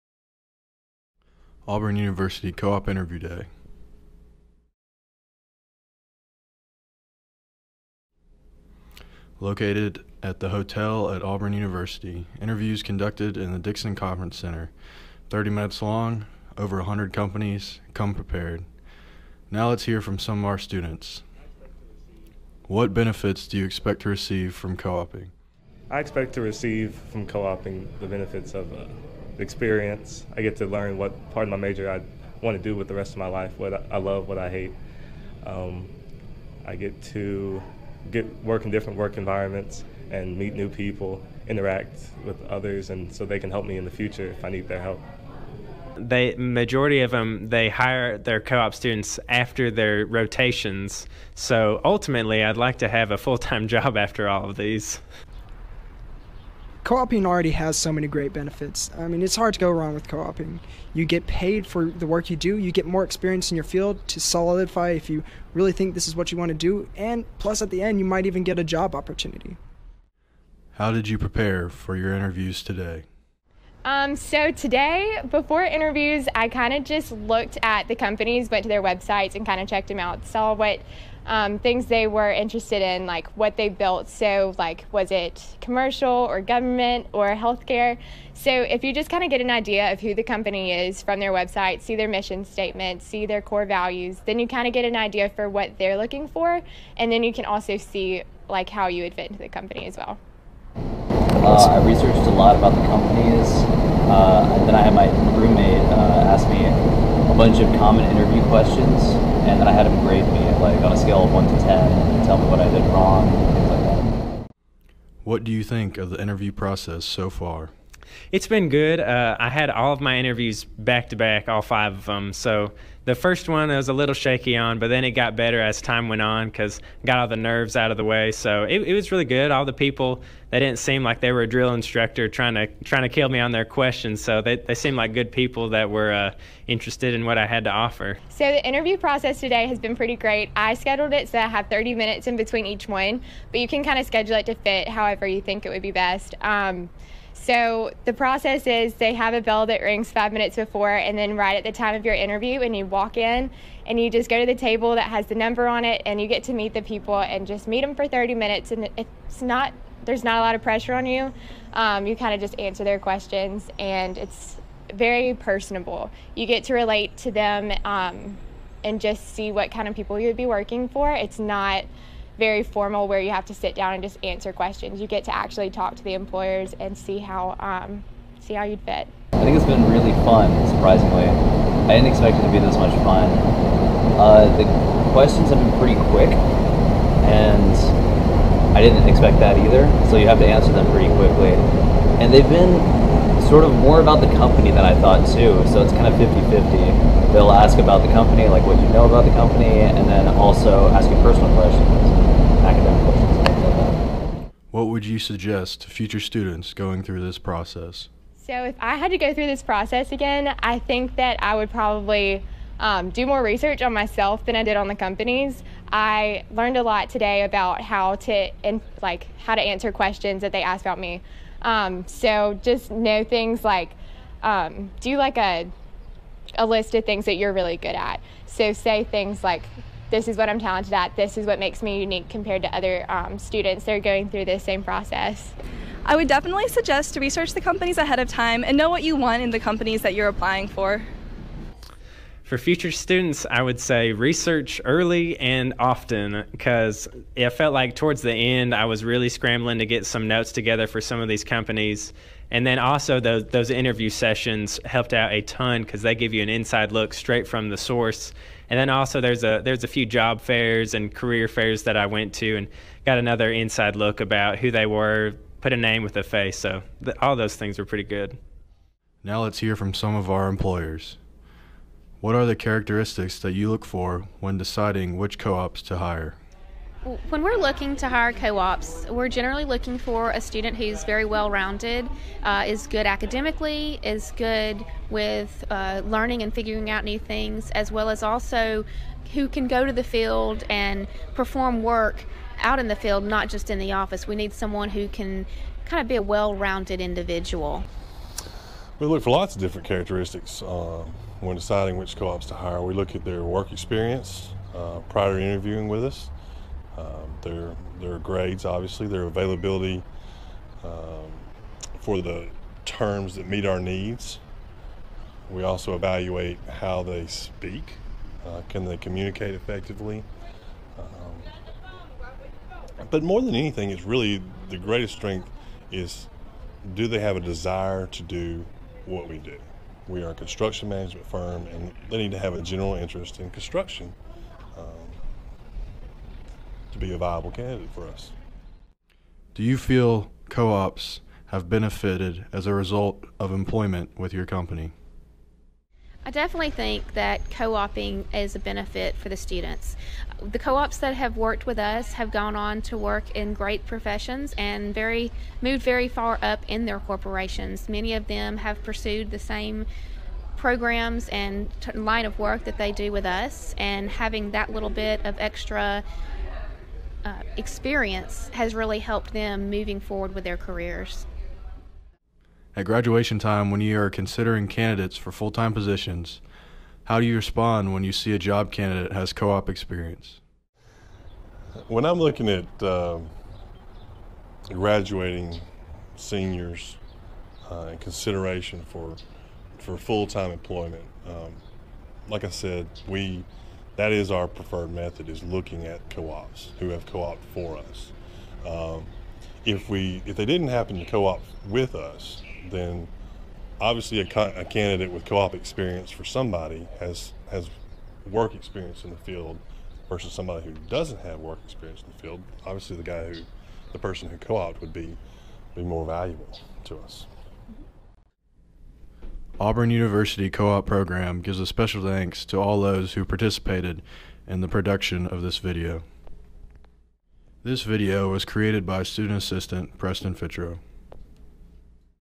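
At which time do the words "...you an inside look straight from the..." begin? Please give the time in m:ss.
4:16.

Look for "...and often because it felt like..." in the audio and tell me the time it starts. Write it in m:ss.
4:05.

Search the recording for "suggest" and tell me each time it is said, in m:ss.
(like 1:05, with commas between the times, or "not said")
3:25, 3:56.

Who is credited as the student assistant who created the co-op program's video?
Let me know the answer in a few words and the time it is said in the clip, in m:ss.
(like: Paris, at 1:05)
Preston Fitro, at 7:09.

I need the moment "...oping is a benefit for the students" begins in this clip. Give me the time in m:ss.
5:47.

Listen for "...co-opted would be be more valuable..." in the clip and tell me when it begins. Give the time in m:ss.
6:54.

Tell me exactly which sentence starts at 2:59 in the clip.
I think it's been really fun, surprisingly.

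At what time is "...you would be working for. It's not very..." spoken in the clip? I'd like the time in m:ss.
2:50.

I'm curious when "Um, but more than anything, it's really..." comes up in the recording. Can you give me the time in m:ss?
5:20.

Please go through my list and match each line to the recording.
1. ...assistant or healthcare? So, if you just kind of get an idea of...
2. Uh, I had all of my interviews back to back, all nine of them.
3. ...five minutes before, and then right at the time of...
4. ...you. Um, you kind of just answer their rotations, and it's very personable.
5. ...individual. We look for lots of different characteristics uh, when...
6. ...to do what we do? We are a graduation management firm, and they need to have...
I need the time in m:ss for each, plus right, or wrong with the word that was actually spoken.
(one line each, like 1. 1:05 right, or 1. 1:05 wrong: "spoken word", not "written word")
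1. 1:26 wrong: "government", not "assistant"
2. 1:58 wrong: "five", not "nine"
3. 2:30 right
4. 2:41 wrong: "questions", not "rotations"
5. 4:57 right
6. 5:28 wrong: "construction", not "graduation".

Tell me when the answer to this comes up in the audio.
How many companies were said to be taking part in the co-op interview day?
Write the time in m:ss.
0:16.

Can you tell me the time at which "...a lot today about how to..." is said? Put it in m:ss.
3:36.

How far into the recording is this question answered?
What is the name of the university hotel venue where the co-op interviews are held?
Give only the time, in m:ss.
0:13.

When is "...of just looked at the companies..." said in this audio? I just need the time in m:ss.
1:16.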